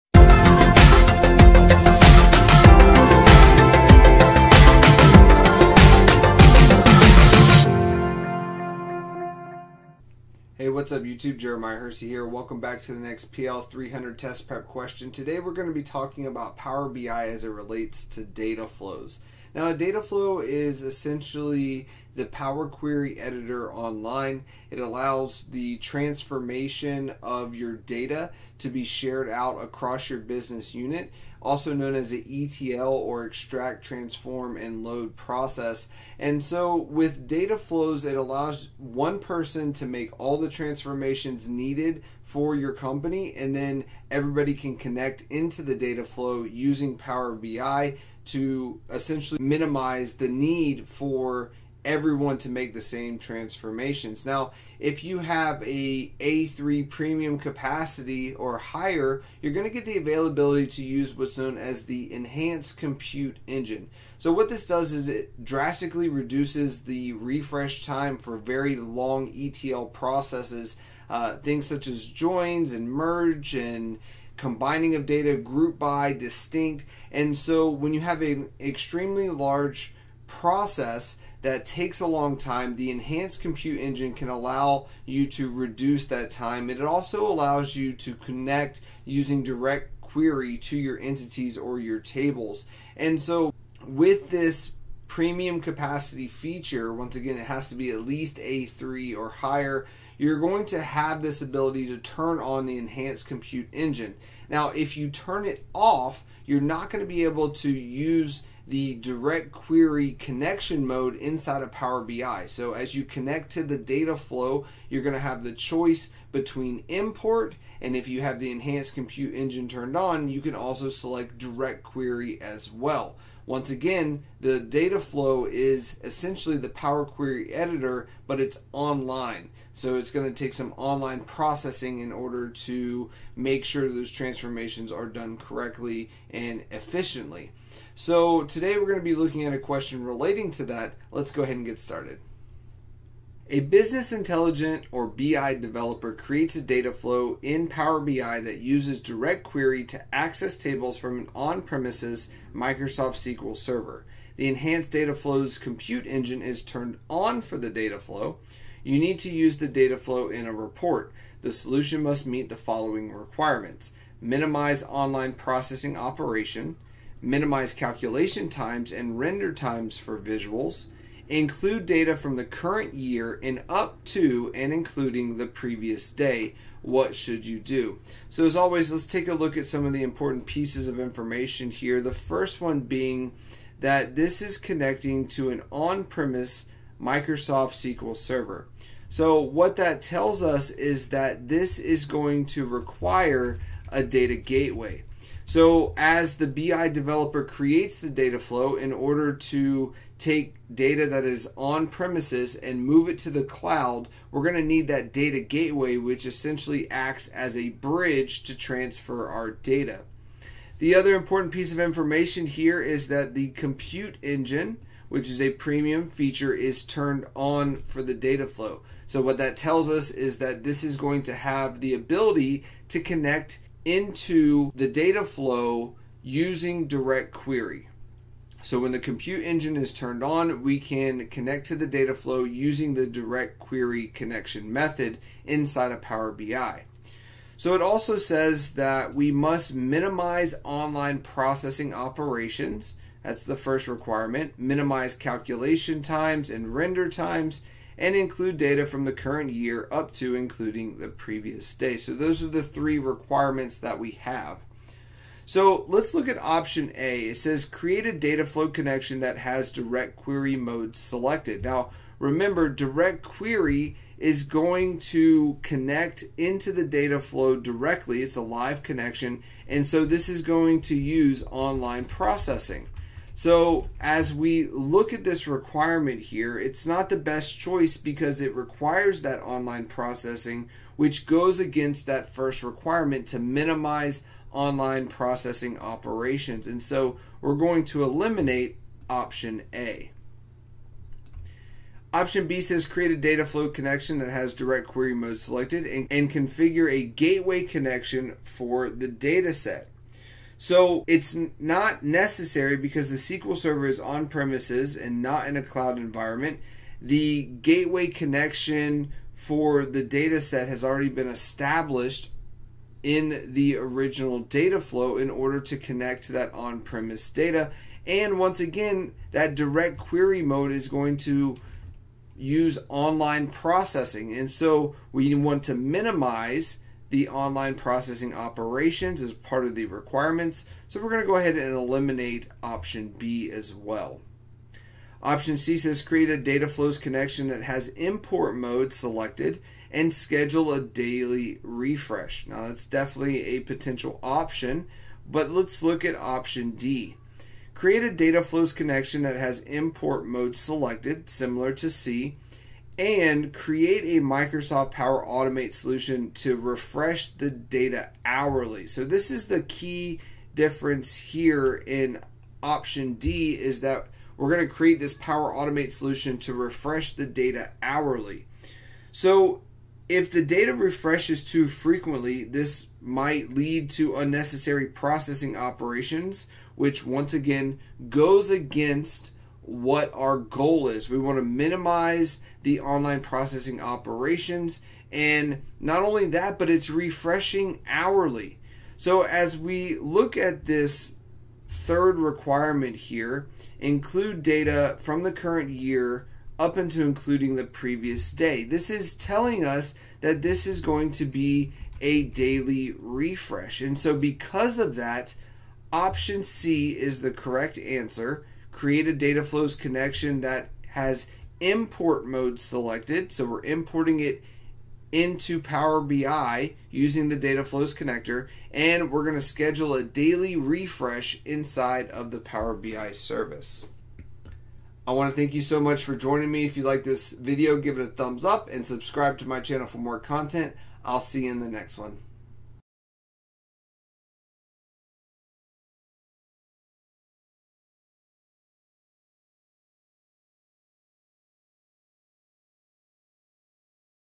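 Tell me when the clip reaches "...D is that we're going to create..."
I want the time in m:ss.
6:03.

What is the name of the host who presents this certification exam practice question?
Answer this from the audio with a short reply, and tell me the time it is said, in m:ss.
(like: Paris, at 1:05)
Jeremiah Hersey, at 0:11.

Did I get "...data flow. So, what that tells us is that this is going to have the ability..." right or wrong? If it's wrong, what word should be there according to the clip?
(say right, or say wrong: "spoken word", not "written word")
right.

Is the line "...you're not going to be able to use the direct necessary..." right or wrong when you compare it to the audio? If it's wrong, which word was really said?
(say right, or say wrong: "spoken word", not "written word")
wrong: "query", not "necessary".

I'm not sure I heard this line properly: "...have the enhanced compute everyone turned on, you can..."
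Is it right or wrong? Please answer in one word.
wrong.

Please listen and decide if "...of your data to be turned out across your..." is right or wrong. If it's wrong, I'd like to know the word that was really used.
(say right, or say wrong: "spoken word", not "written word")
wrong: "shared", not "turned".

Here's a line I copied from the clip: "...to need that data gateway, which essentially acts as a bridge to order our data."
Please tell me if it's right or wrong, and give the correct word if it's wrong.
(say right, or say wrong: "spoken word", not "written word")
wrong: "transfer", not "order".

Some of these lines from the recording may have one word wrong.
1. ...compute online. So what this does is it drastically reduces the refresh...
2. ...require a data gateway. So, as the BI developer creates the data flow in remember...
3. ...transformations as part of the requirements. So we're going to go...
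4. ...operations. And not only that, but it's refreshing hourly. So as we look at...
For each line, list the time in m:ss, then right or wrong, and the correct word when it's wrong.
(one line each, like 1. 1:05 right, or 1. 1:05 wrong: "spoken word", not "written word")
1. 1:02 wrong: "engine", not "online"
2. 3:12 wrong: "order", not "remember"
3. 5:28 wrong: "operations", not "transformations"
4. 6:23 right.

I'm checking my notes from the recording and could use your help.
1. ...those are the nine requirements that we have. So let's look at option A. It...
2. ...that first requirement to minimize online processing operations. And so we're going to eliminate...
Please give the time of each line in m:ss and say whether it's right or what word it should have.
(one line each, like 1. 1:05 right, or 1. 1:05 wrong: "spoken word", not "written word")
1. 4:12 wrong: "three", not "nine"
2. 4:42 right.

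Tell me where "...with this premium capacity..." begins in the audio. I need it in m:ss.
1:33.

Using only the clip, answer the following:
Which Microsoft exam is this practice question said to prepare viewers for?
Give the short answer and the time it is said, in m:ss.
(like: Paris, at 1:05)
PL300, at 0:13.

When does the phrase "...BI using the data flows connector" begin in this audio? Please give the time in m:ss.
6:56.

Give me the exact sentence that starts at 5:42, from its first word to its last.
Now that's definitely a potential option, but let's look at option D.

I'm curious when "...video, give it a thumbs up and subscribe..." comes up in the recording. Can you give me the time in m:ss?
7:07.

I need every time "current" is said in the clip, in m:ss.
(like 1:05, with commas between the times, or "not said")
2:52, 4:09, 6:35.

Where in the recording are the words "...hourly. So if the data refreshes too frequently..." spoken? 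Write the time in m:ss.
6:07.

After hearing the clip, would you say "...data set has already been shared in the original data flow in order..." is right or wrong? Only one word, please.
wrong.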